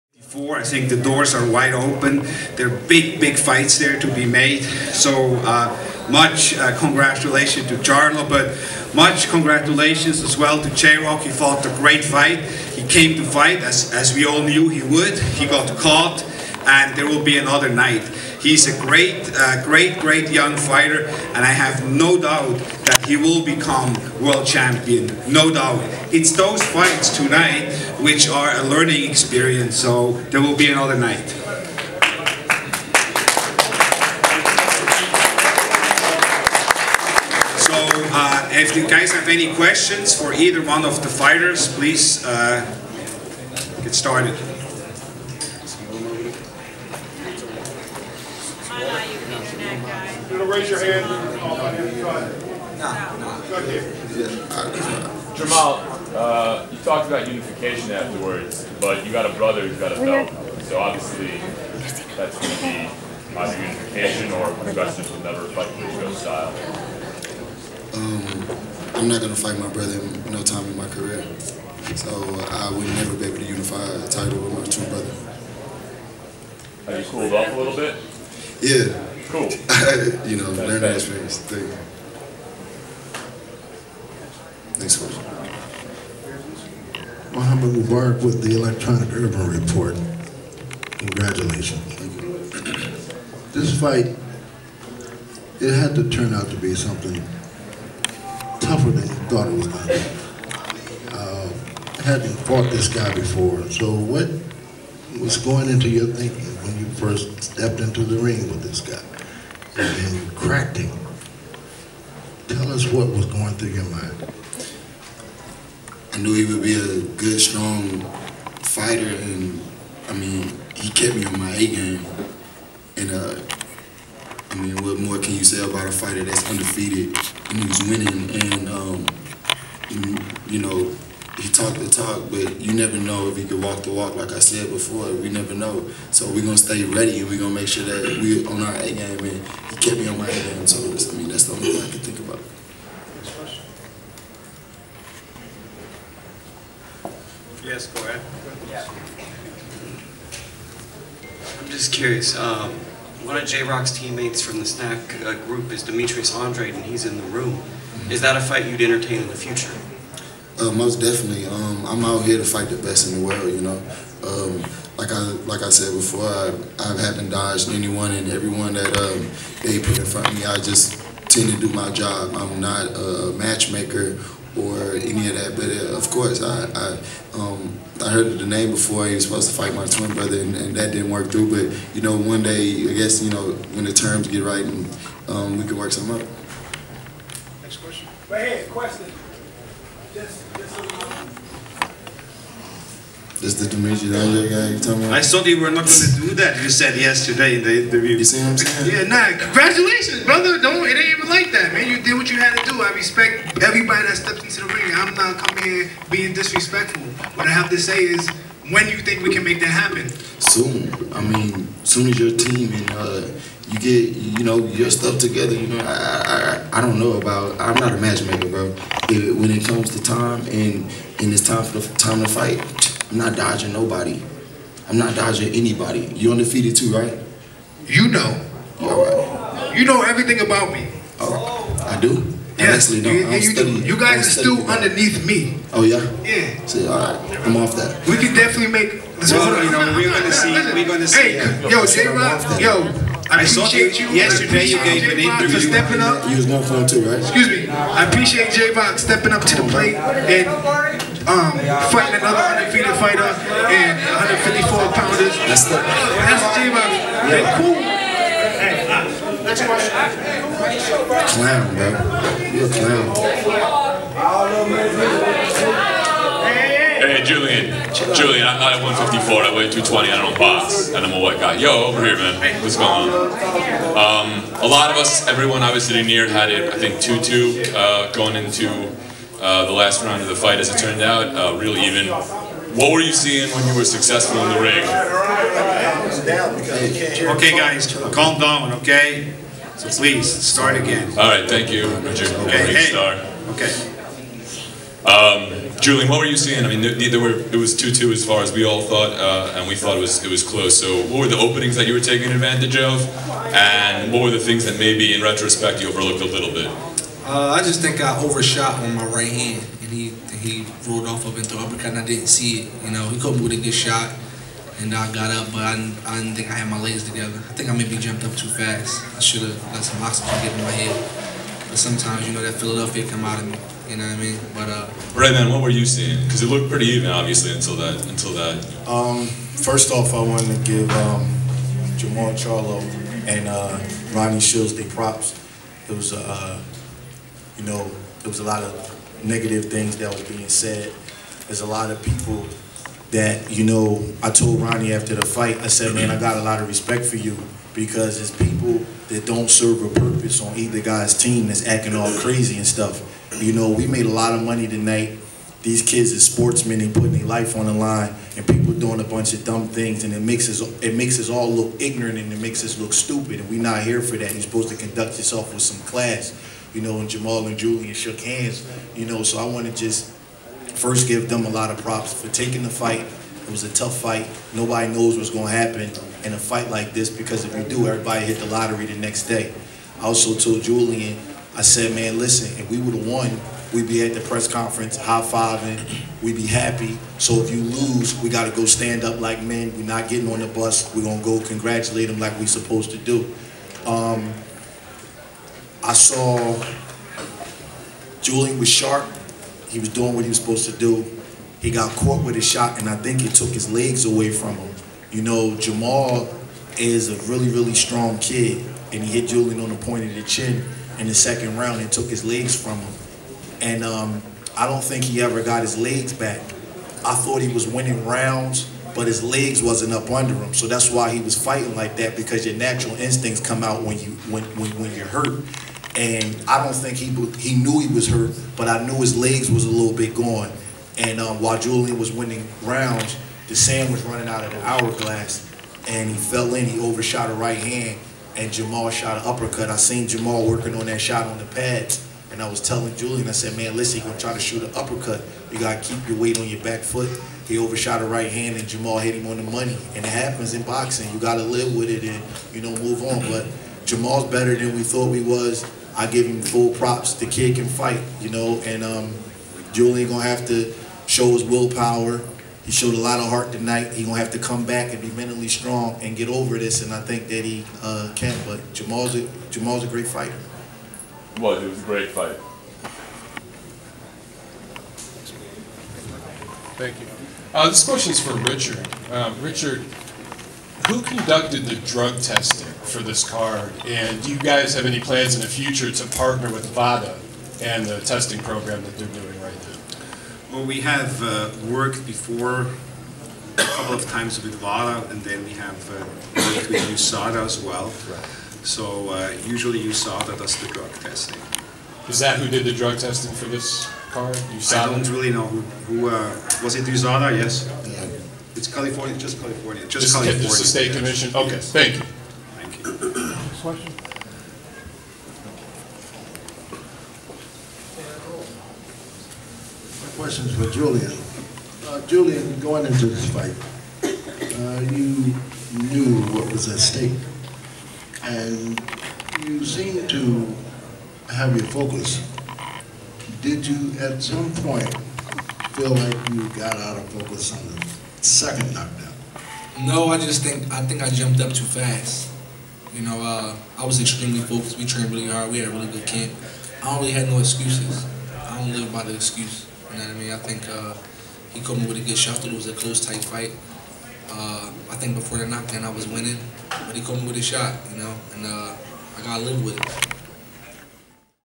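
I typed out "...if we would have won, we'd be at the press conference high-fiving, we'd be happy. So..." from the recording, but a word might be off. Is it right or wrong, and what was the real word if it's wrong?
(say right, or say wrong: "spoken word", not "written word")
right.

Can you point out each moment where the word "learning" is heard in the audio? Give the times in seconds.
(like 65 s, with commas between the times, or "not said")
28 s, 80 s.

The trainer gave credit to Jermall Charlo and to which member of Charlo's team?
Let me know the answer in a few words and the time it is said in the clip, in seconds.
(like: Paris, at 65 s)
Ronnie Shields, at 334 s.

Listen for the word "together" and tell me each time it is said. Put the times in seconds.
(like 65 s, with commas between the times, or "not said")
215 s, 317 s.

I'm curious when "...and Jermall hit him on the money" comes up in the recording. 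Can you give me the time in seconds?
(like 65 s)
448 s.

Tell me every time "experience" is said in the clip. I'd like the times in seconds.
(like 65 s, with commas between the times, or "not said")
29 s, 80 s.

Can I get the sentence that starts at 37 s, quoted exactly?
So uh, if you guys have any questions for either one of the fighters, please uh, get started.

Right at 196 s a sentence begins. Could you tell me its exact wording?
You said yesterday in the interview.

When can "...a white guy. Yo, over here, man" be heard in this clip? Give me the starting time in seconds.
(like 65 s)
271 s.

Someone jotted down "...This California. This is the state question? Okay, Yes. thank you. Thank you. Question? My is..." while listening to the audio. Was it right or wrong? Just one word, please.
wrong.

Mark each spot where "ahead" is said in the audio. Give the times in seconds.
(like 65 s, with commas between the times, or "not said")
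53 s, 148 s.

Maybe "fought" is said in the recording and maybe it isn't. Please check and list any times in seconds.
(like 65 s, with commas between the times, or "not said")
11 s, 102 s.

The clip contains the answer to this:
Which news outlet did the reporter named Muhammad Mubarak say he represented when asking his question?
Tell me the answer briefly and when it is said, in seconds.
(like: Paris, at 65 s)
Electronic Urban Report, at 88 s.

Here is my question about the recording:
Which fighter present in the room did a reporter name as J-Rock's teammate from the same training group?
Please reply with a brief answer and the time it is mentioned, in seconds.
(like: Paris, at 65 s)
Demetrius Andrade, at 155 s.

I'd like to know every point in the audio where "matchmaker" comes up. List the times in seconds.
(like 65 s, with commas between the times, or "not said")
173 s, 217 s.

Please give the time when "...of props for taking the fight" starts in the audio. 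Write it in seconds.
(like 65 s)
371 s.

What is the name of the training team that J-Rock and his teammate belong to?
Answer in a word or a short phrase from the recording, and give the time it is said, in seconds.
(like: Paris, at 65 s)
SNAC, at 154 s.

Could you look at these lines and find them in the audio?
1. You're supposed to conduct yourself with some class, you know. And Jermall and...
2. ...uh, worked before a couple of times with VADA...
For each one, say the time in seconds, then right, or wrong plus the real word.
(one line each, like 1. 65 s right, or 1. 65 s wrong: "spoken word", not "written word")
1. 364 s right
2. 491 s right.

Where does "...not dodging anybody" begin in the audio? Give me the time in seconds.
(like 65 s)
224 s.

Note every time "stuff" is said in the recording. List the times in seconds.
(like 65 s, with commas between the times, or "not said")
214 s, 352 s.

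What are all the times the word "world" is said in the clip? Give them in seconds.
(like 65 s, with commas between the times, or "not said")
24 s, 163 s.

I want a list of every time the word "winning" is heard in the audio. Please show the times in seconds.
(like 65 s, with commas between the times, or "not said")
127 s, 417 s, 432 s, 556 s.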